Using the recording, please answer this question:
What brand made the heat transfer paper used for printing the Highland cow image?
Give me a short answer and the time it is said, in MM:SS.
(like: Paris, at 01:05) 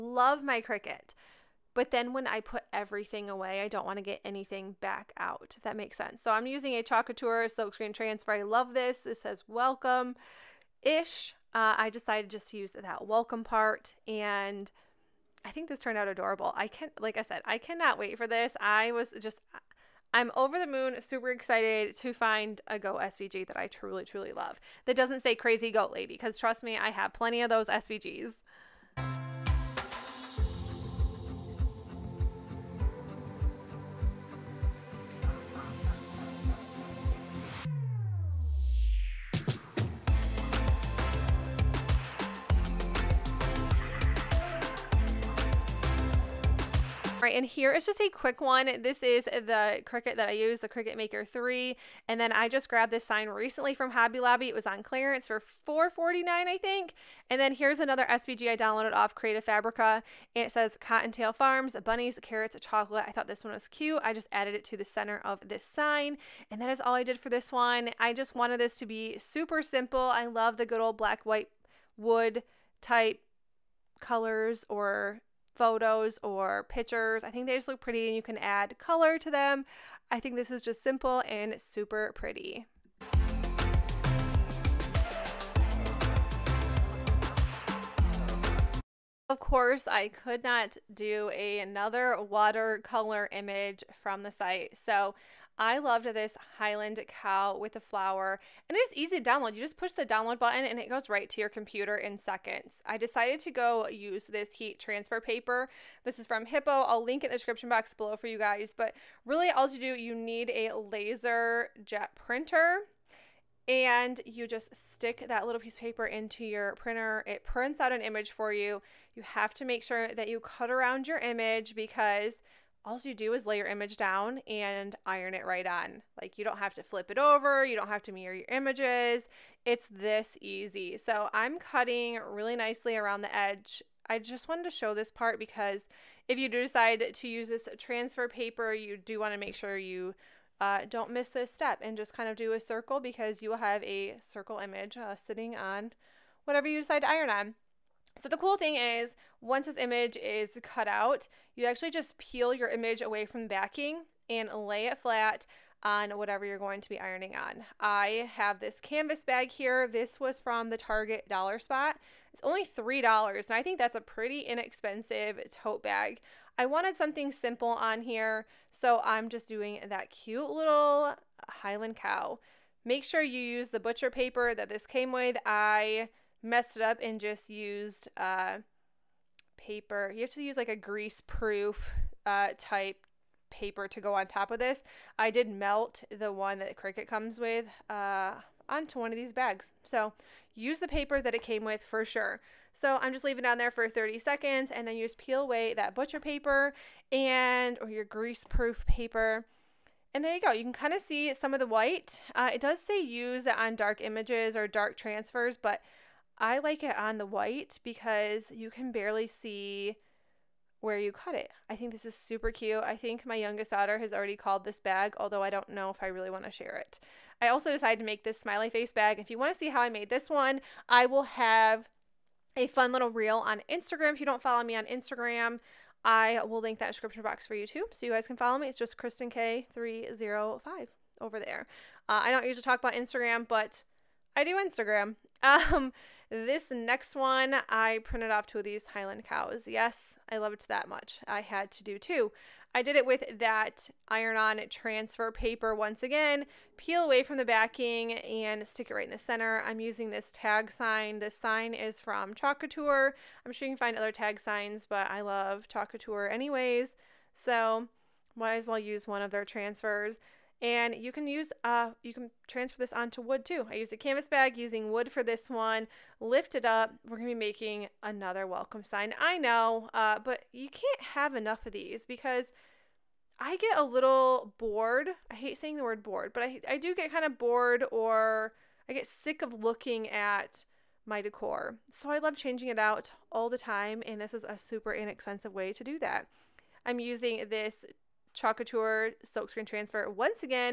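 Hippo, at 01:46.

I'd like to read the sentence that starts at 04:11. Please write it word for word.
This sign is from Chalk Couture.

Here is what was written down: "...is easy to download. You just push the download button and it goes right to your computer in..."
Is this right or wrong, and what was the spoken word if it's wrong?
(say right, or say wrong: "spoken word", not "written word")
right.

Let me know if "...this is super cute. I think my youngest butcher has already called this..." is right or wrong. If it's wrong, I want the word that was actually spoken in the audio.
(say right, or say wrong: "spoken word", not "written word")
wrong: "daughter", not "butcher".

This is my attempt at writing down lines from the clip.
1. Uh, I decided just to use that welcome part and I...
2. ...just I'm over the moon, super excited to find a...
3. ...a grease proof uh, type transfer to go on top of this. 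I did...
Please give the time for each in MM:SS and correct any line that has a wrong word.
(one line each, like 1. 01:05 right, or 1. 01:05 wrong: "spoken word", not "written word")
1. 00:11 right
2. 00:19 right
3. 03:00 wrong: "paper", not "transfer".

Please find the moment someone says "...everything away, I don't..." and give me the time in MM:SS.
00:02.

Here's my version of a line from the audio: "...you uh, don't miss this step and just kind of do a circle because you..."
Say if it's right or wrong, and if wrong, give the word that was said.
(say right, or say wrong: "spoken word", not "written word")
right.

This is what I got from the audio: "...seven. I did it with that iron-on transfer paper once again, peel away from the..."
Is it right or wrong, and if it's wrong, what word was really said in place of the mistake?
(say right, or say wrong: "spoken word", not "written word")
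wrong: "two", not "seven".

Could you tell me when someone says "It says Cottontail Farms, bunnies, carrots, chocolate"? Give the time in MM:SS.
01:00.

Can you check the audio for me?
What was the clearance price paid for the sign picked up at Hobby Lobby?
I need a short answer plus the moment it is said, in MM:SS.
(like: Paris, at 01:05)
$4.49, at 00:55.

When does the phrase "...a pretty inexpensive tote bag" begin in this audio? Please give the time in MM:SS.
02:43.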